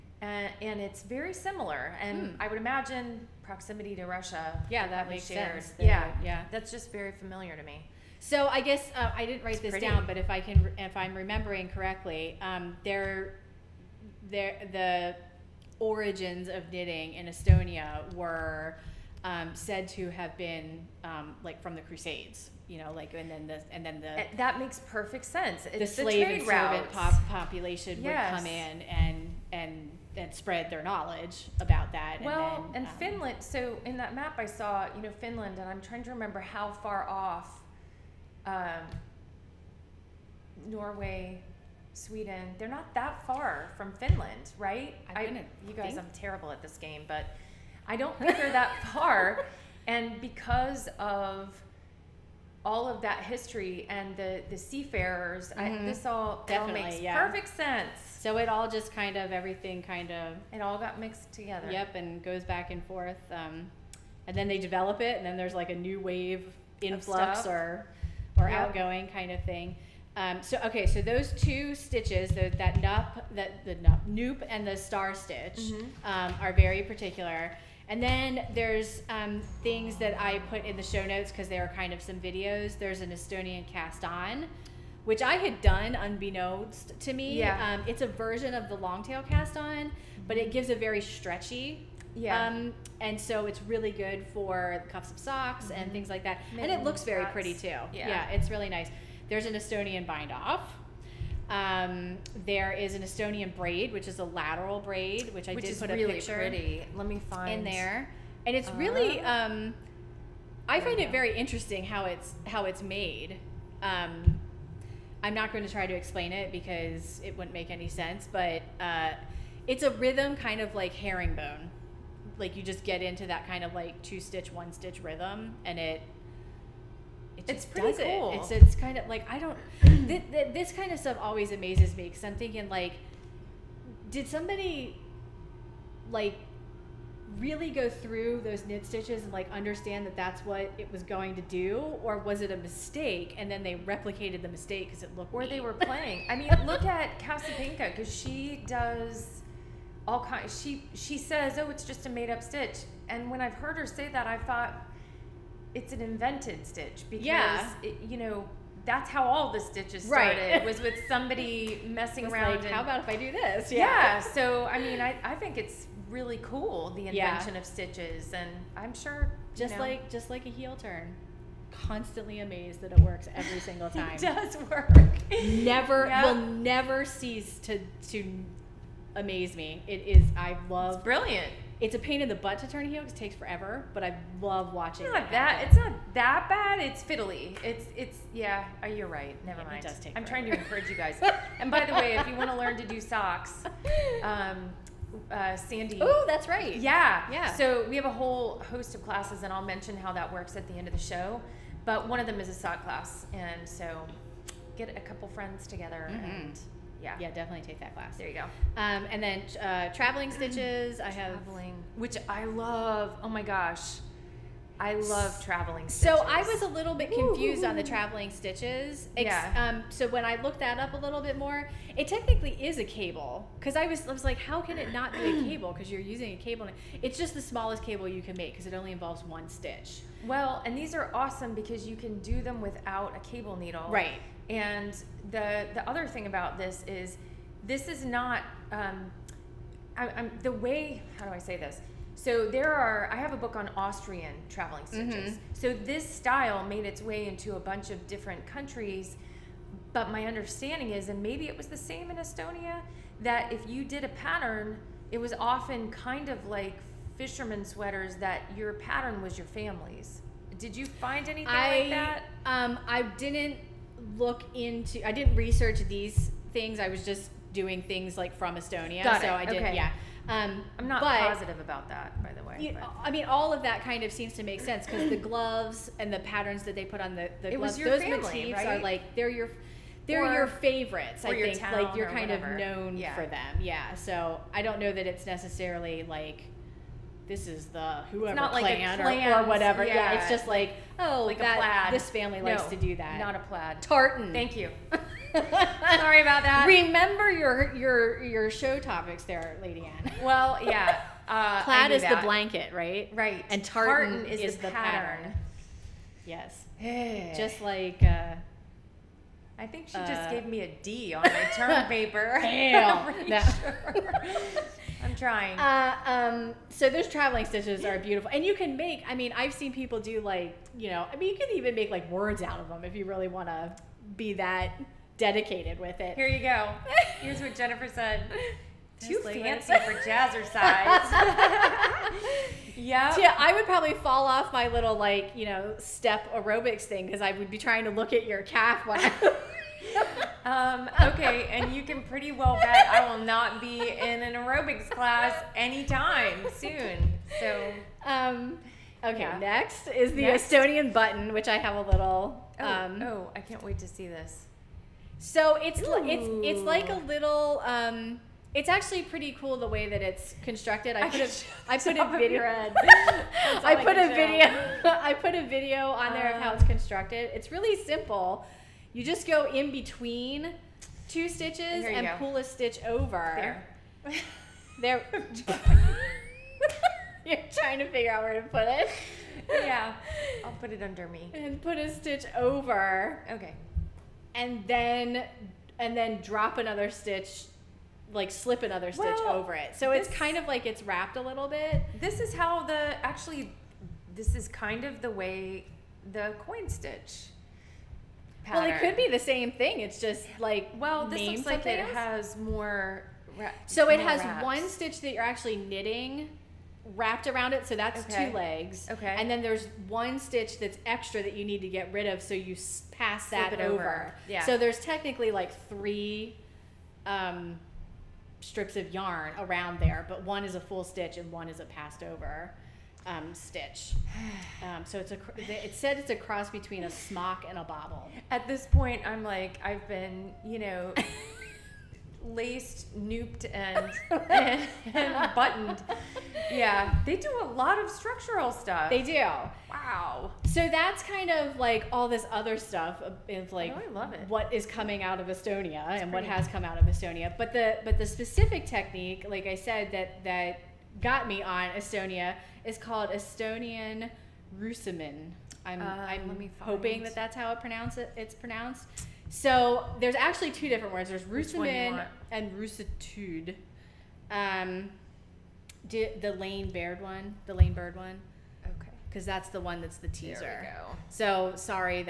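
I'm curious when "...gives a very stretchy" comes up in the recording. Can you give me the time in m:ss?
1:30.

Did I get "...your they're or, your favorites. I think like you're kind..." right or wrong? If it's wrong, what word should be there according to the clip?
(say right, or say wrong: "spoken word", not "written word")
right.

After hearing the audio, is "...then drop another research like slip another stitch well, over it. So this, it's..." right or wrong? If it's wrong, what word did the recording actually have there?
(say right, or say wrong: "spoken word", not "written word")
wrong: "stitch", not "research".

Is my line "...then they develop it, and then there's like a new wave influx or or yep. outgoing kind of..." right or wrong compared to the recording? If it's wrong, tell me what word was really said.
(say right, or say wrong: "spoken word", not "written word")
right.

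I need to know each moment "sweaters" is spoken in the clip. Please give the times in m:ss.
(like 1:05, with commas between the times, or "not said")
4:17.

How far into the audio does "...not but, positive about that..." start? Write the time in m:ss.
4:30.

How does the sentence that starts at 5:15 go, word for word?
Uh, um, so those traveling stitches are beautiful, and you can make.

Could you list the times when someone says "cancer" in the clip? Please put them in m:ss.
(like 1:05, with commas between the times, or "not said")
not said.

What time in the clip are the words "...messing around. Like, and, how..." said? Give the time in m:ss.
2:41.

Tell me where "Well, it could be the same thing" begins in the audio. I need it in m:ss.
6:38.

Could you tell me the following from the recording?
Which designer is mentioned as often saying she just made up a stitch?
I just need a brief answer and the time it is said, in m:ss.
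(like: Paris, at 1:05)
Casapinka, at 2:27.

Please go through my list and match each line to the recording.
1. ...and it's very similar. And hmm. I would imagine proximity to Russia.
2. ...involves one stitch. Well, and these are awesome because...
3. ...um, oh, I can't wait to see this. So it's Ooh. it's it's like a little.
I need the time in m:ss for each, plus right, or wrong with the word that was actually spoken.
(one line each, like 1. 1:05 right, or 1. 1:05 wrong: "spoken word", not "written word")
1. 0:00 right
2. 3:48 right
3. 5:52 right.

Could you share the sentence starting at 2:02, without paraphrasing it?
Like you just get into that kind of like two stitch, one stitch rhythm, and it it it's pretty cool.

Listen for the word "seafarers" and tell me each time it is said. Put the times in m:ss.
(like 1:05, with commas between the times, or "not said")
0:54.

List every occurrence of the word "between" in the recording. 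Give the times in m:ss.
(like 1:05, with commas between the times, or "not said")
6:09, 7:06.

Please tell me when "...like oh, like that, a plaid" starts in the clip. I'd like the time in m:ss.
4:50.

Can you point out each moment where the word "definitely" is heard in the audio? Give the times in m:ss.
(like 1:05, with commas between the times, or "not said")
0:56, 3:27.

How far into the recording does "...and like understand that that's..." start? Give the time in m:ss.
2:19.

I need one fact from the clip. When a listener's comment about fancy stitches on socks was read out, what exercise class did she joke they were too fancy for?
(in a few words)
Jazzercise.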